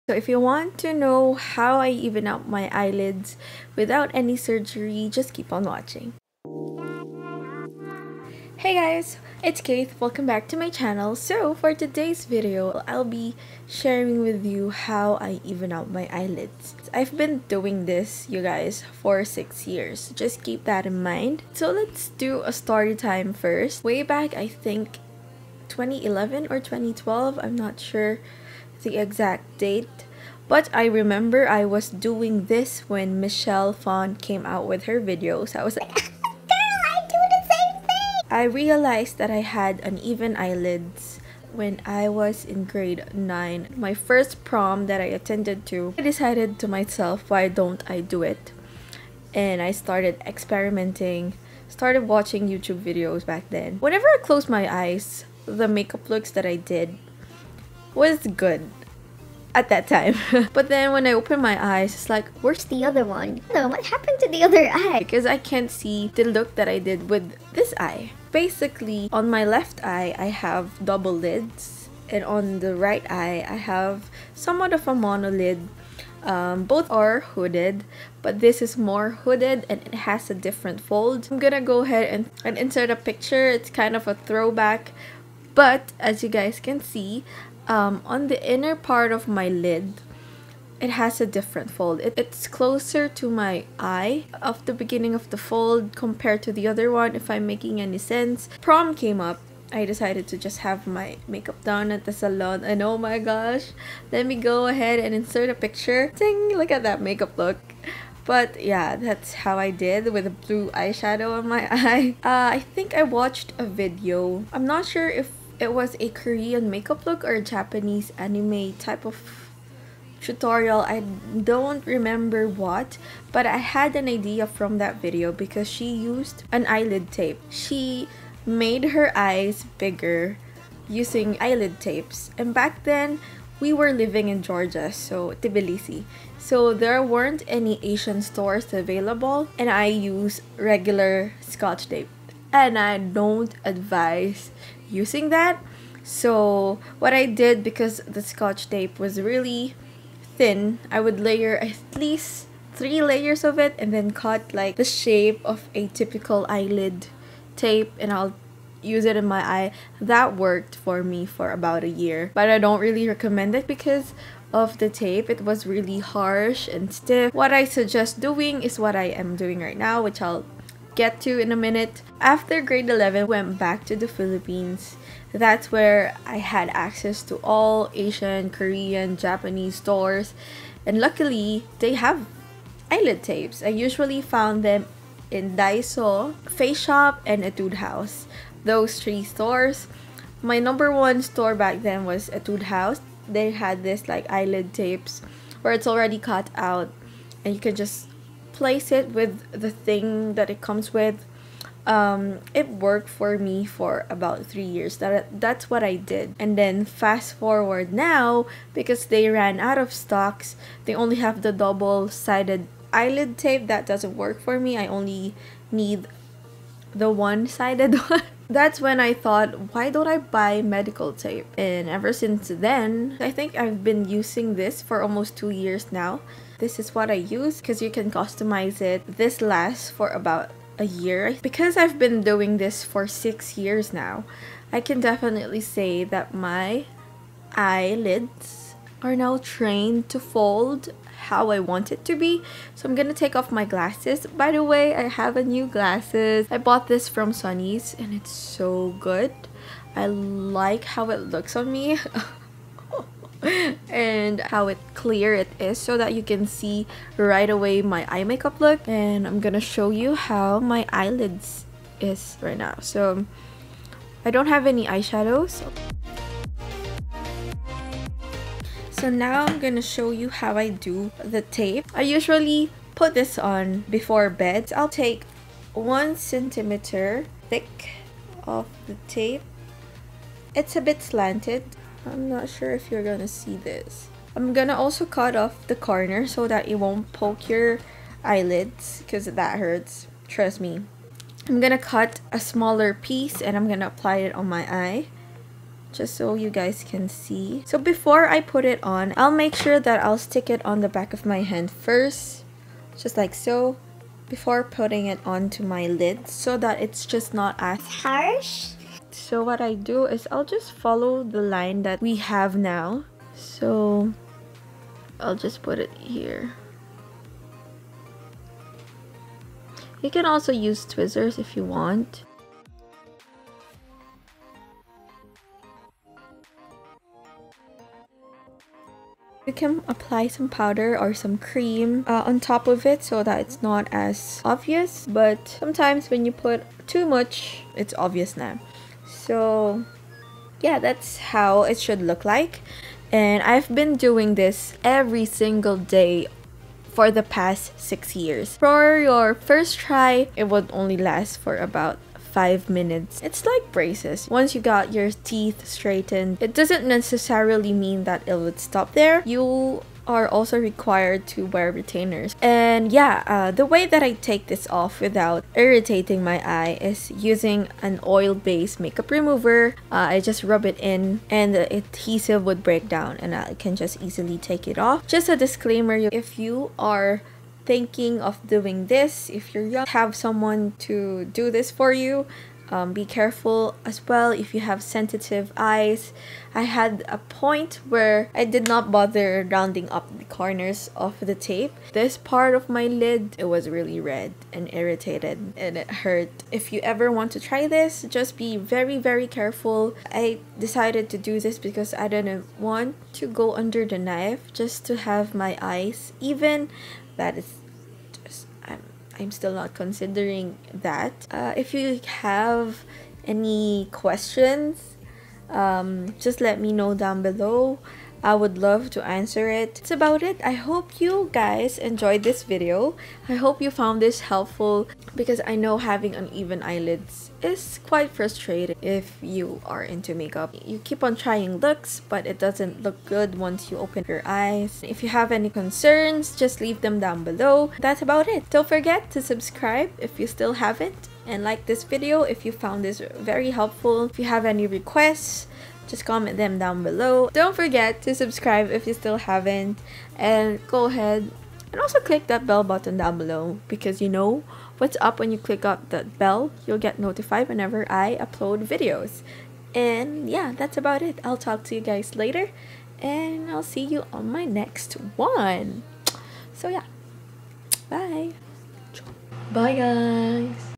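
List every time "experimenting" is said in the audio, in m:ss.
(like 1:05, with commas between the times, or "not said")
0:50.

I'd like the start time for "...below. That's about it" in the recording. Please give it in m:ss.
7:17.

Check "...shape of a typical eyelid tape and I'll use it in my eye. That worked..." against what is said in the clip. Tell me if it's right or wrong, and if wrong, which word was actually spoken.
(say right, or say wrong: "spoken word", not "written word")
right.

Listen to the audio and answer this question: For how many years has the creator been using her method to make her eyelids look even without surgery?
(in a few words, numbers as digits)
6.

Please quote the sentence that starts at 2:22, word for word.
And I don't advise using that.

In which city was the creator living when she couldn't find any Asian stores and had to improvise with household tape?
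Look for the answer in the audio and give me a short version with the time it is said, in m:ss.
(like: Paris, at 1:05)
Tbilisi, at 2:15.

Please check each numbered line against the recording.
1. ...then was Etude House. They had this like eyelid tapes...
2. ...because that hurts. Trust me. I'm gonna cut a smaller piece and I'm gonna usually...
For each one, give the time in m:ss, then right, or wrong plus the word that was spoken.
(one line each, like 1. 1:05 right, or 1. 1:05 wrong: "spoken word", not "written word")
1. 3:11 right
2. 4:49 wrong: "apply", not "usually".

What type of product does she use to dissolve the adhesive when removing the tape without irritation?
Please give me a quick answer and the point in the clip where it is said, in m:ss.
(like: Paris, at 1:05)
oil-based makeup remover, at 6:08.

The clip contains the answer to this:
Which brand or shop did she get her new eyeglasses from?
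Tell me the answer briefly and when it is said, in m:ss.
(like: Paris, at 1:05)
Sunnies, at 4:07.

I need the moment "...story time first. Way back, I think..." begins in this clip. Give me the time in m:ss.
0:22.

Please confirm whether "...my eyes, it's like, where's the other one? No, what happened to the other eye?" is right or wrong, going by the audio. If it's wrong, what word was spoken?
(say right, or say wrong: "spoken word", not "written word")
right.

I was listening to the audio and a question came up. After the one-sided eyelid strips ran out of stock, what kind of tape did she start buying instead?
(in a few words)
medical tape.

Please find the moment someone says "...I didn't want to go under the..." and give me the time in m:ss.
6:41.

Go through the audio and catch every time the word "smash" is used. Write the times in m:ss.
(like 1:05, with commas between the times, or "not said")
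not said.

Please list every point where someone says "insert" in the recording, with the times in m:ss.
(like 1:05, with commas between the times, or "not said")
1:22, 1:45.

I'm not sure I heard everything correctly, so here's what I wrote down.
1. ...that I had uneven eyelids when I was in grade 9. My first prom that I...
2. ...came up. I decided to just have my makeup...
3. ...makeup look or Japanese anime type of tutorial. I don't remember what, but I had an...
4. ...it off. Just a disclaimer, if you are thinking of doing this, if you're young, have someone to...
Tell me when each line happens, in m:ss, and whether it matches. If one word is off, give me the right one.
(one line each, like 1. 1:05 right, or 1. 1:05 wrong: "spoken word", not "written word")
1. 0:39 right
2. 1:38 right
3. 1:56 right
4. 6:14 right.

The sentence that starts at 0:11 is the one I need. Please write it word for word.
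So for today's video, I'll be sharing with you how I even out my eyelids.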